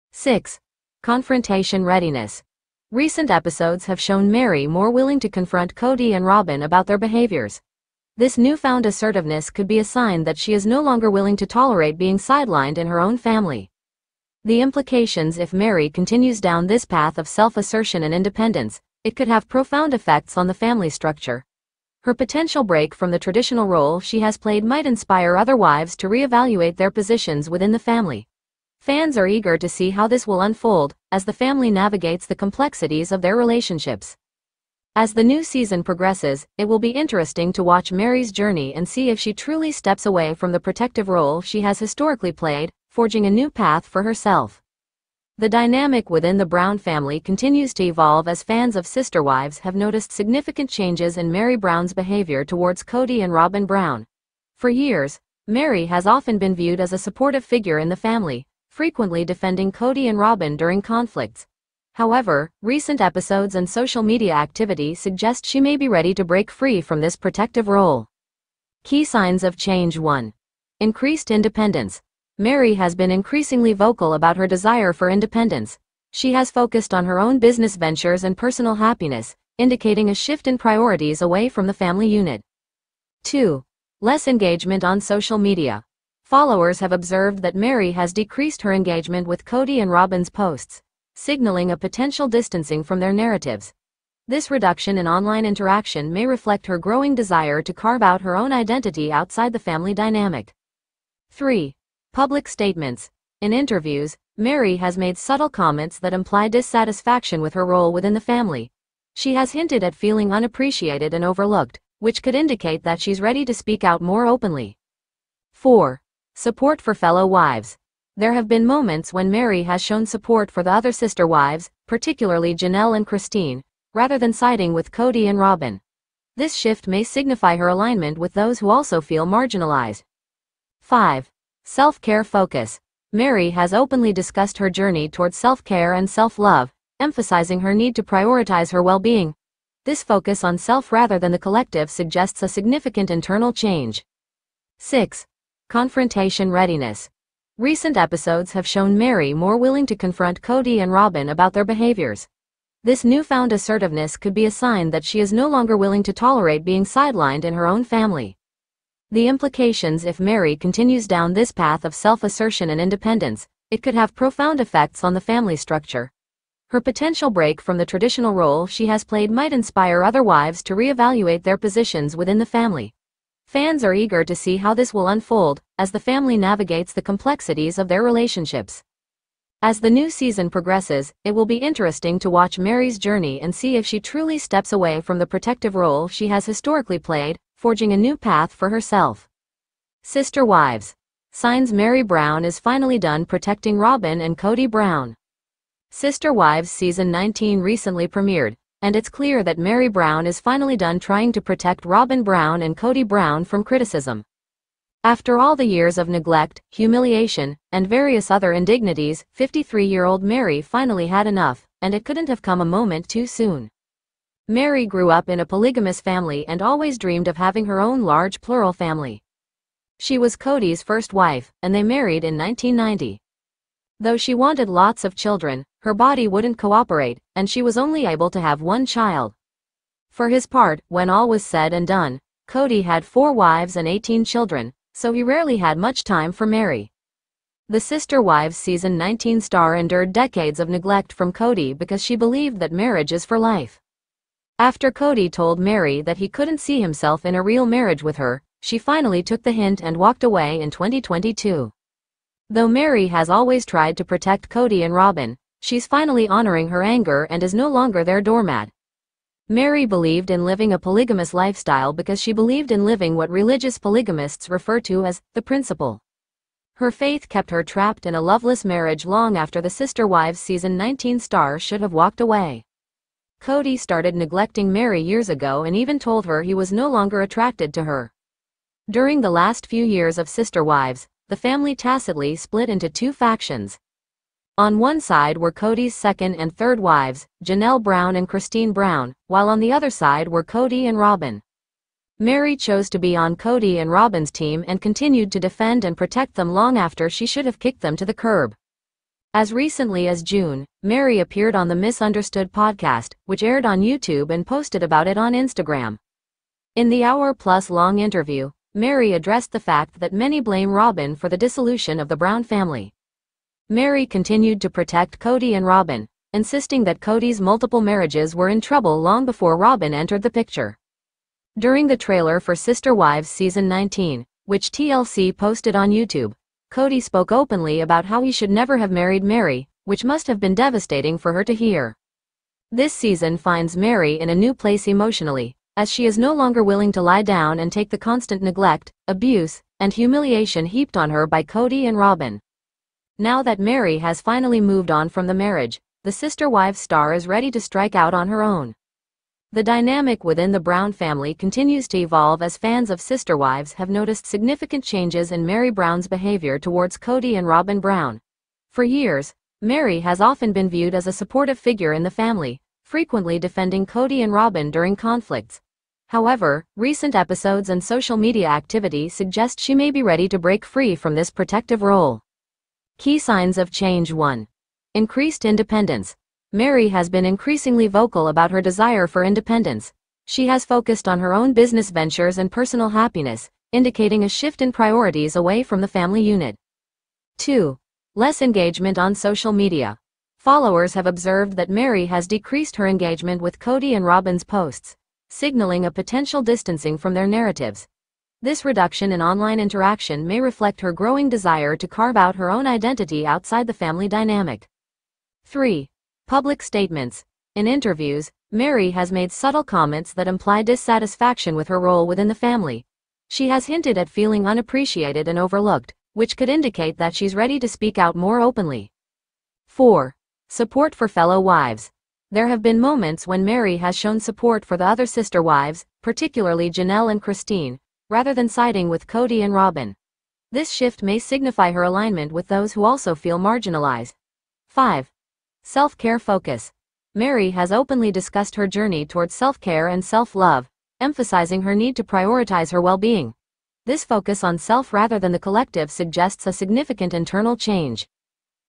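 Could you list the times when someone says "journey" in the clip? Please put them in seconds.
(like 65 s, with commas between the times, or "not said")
38 s, 134 s, 182 s, 438 s.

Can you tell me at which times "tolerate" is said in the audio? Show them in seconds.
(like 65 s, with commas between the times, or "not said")
11 s, 156 s.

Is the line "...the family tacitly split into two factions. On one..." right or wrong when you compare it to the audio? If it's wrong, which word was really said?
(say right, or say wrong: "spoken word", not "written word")
right.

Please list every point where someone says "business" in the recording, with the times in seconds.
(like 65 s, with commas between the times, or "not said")
77 s, 381 s.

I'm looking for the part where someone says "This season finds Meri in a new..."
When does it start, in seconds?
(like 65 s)
332 s.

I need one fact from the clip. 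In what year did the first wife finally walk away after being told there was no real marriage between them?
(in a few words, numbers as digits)
2022.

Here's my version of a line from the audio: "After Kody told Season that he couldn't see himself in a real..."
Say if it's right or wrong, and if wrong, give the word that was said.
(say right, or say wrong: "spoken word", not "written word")
wrong: "Meri", not "Season".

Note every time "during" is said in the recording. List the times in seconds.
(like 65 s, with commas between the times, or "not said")
60 s, 278 s, 321 s, 364 s.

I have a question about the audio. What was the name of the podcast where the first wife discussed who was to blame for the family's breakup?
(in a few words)
Misunderstood.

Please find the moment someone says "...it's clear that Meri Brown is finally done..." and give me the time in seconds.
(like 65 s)
198 s.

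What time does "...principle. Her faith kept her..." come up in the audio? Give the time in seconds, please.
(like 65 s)
265 s.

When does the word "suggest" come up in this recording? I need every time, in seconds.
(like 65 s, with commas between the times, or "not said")
64 s, 141 s, 369 s, 445 s.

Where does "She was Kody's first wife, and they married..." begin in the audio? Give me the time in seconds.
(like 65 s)
219 s.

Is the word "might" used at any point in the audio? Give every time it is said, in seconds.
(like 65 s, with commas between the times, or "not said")
24 s, 169 s.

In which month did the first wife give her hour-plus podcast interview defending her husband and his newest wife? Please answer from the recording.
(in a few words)
June.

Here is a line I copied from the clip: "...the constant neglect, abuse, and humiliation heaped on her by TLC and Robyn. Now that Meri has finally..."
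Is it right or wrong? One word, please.
wrong.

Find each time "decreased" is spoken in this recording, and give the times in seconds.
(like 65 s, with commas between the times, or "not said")
88 s, 392 s.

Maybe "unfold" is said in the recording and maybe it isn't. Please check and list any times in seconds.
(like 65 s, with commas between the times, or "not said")
30 s, 175 s.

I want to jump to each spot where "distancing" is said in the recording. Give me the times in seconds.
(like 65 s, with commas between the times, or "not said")
92 s, 396 s.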